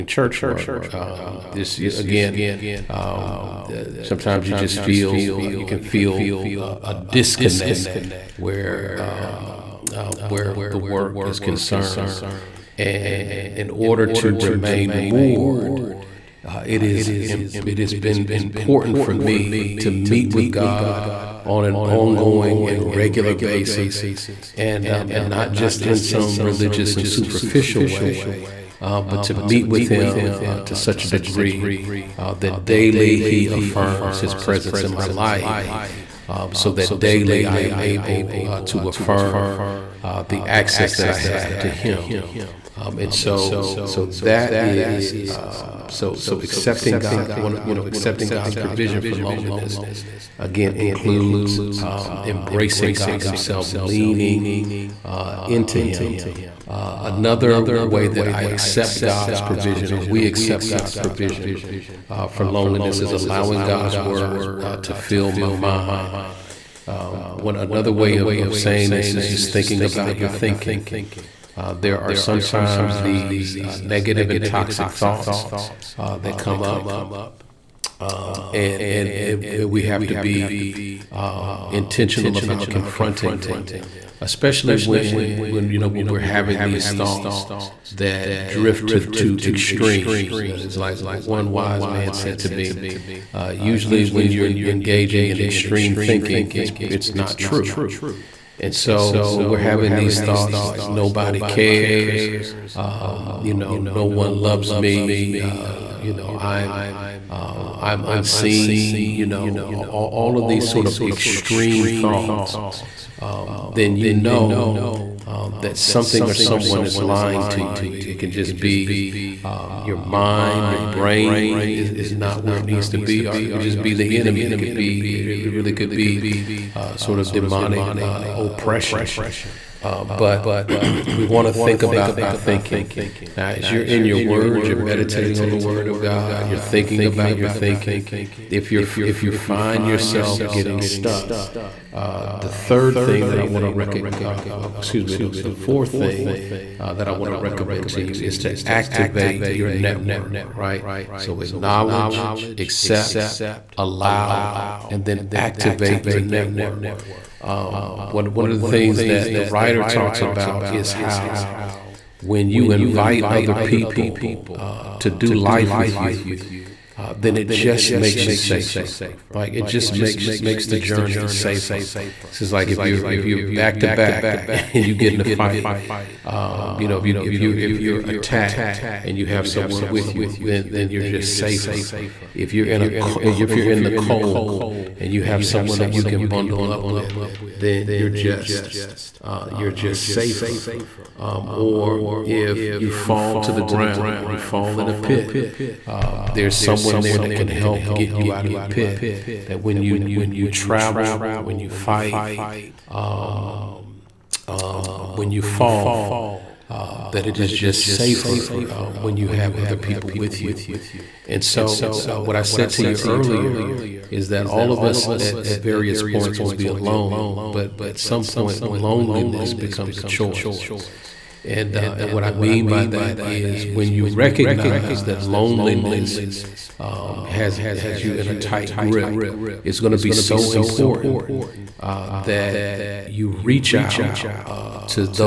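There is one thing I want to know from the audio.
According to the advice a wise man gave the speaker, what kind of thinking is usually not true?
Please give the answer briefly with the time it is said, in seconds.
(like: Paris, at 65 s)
Extreme thinking, at 95 s.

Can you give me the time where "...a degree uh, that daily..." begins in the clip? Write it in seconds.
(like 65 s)
31 s.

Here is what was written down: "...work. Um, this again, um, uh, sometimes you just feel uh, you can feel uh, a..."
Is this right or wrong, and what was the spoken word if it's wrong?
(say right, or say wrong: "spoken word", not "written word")
right.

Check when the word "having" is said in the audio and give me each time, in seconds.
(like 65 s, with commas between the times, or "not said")
86 s, 99 s.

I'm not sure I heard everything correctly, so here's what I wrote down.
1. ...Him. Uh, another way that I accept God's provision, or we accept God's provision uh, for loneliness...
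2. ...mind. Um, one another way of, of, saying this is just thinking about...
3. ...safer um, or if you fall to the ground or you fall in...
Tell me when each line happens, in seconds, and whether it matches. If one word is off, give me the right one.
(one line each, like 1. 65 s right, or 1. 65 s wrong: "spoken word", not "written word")
1. 55 s right
2. 65 s right
3. 190 s right.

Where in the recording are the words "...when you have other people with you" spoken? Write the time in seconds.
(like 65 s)
209 s.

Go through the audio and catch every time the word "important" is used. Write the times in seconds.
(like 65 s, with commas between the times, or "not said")
18 s, 230 s.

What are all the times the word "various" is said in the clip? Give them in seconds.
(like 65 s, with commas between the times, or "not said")
215 s.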